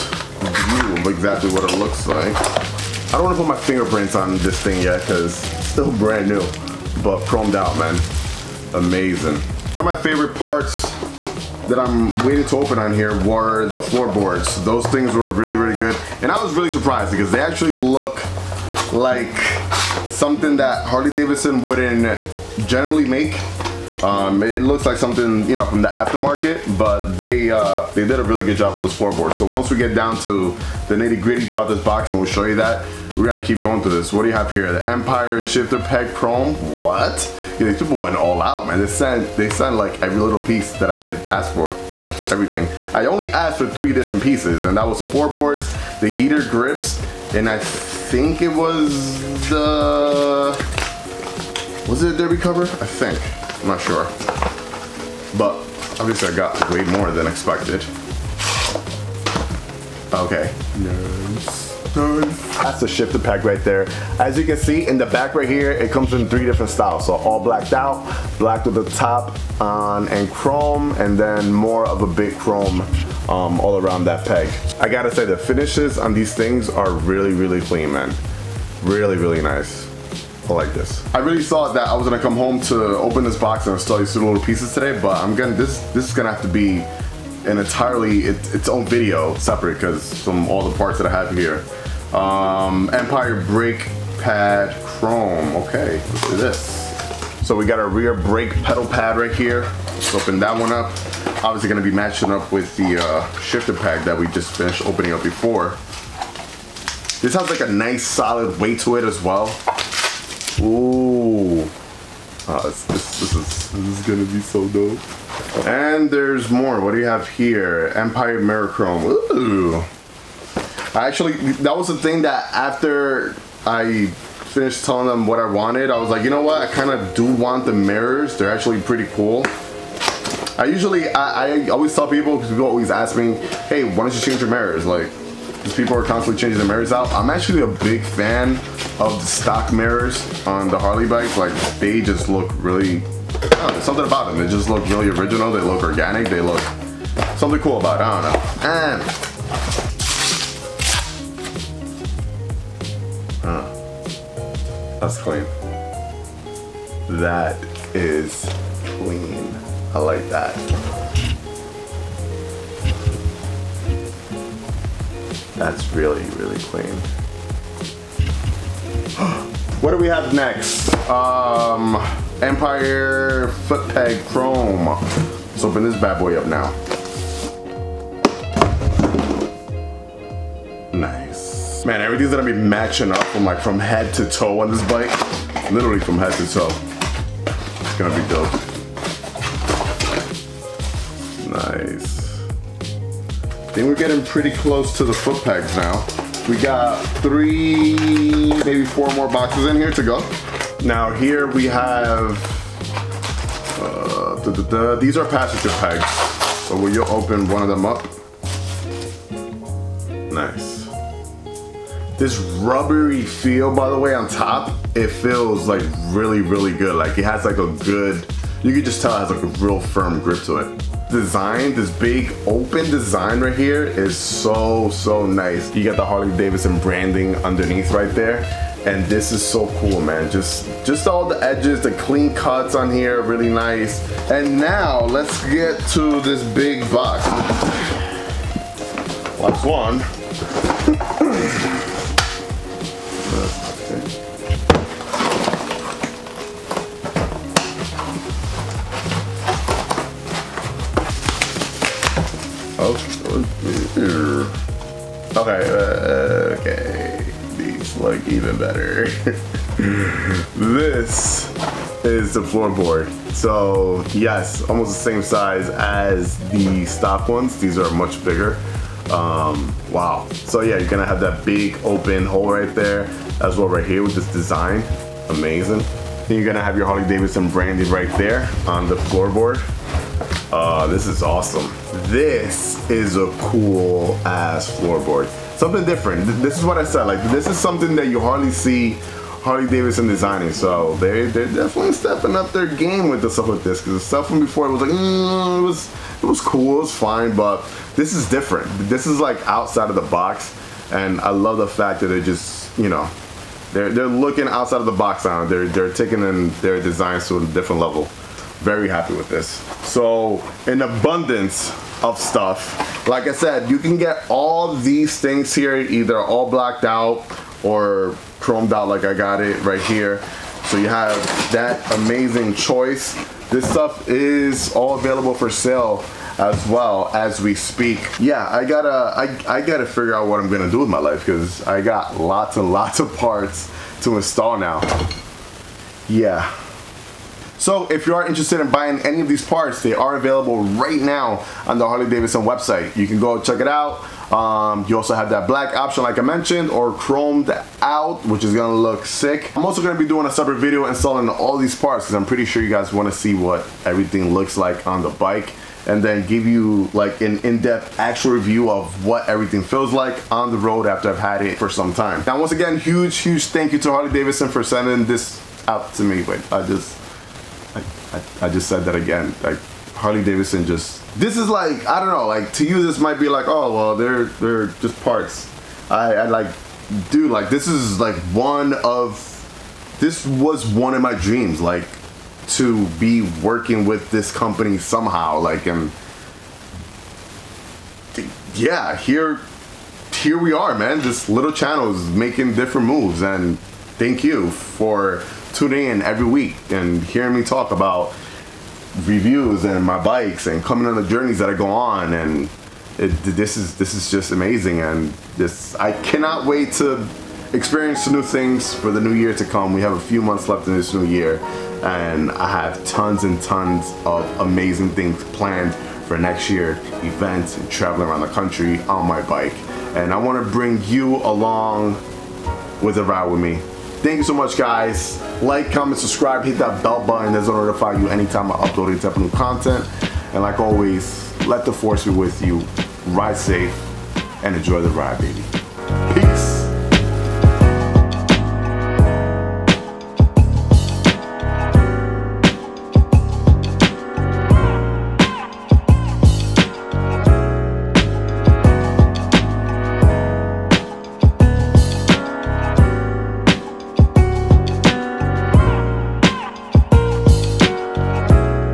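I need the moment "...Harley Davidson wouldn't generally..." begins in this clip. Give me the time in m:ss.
0:20.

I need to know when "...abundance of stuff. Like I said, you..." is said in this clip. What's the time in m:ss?
5:10.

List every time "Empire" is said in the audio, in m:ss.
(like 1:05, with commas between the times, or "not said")
0:34, 1:32, 1:57, 2:52.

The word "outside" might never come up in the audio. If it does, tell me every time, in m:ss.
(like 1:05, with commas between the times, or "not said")
4:59, 5:04.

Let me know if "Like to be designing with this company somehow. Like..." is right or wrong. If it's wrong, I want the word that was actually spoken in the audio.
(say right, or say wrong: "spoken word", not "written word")
wrong: "working", not "designing".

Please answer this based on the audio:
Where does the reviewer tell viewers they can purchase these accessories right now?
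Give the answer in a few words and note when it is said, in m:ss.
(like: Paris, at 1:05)
Harley Davidson website, at 5:41.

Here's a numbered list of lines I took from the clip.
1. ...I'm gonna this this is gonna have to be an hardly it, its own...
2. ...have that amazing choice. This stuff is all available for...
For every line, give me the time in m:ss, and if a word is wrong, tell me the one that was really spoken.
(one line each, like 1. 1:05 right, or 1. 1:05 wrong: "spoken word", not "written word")
1. 1:25 wrong: "entirely", not "hardly"
2. 5:20 right.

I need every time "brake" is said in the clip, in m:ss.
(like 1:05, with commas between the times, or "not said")
1:33, 1:38.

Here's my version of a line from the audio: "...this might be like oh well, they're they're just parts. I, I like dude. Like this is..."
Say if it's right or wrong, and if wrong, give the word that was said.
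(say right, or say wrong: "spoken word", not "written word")
right.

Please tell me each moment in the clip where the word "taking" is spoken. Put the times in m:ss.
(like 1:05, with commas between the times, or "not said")
5:05.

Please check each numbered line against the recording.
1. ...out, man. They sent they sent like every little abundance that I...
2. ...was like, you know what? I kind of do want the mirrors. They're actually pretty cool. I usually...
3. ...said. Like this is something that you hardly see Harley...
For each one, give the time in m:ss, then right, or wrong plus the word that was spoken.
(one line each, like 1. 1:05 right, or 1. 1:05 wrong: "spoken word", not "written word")
1. 0:38 wrong: "piece", not "abundance"
2. 2:05 right
3. 4:46 right.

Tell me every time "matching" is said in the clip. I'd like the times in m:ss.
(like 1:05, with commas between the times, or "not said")
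1:41, 3:02.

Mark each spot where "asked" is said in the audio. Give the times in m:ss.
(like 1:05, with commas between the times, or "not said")
0:43.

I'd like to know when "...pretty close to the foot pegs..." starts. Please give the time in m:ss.
3:14.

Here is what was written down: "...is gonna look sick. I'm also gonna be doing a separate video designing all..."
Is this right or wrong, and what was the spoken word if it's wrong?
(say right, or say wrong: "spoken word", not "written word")
wrong: "installing", not "designing".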